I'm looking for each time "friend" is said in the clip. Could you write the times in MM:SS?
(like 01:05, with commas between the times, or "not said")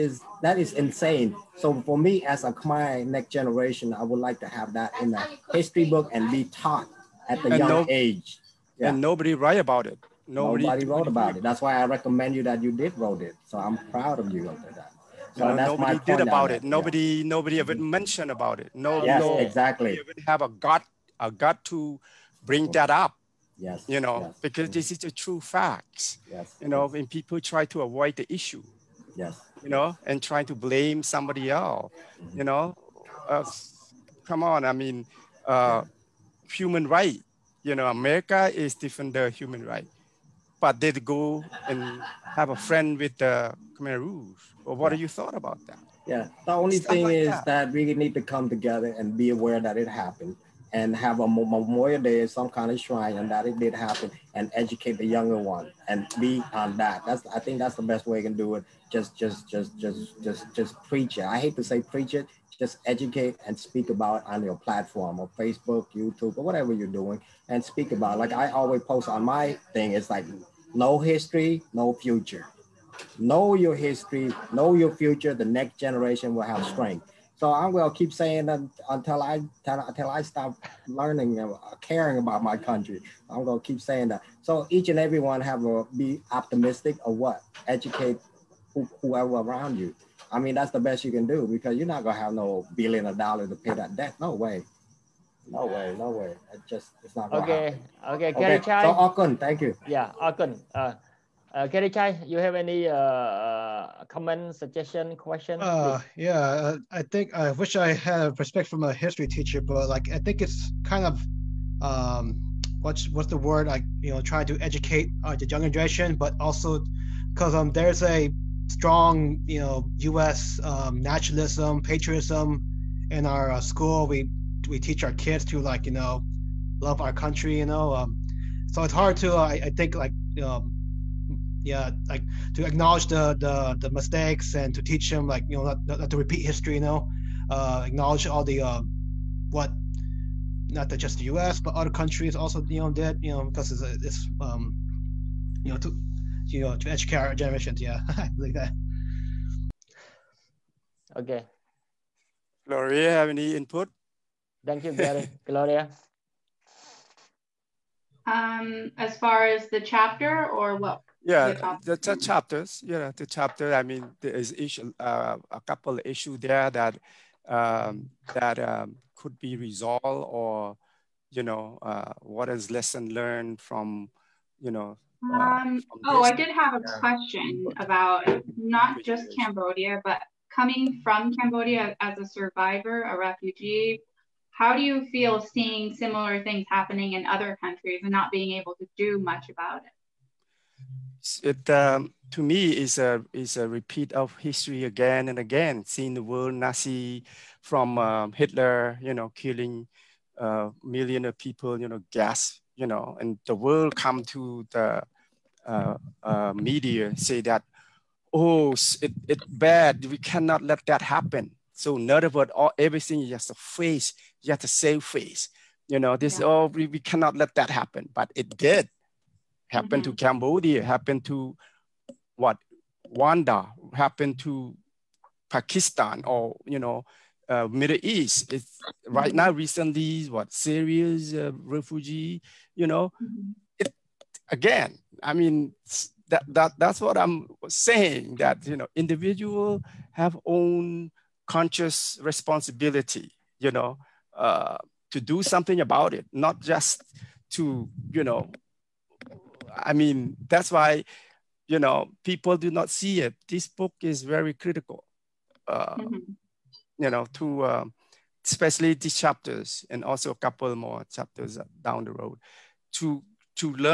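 00:42.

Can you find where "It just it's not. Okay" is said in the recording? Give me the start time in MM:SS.
01:36.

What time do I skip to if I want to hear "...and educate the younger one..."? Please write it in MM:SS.
00:54.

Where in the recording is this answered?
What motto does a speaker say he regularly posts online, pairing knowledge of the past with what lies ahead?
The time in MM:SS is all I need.
01:10.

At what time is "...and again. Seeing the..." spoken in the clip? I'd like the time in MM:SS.
03:15.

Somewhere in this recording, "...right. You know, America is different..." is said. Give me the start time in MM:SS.
00:36.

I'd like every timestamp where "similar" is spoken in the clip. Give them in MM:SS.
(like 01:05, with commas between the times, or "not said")
03:05.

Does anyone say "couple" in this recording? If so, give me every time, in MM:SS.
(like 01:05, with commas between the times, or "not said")
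02:45, 04:20.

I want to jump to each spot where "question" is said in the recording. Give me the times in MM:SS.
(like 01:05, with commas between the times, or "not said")
01:45, 02:56.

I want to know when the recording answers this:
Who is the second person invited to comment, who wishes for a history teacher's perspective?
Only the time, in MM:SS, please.
01:41.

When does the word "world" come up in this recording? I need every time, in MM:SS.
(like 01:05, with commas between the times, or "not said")
03:16, 03:23.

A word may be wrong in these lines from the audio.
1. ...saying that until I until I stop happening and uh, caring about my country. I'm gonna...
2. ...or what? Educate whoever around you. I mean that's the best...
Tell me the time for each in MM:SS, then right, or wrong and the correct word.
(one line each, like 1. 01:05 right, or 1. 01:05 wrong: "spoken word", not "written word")
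1. 01:18 wrong: "learning", not "happening"
2. 01:27 right.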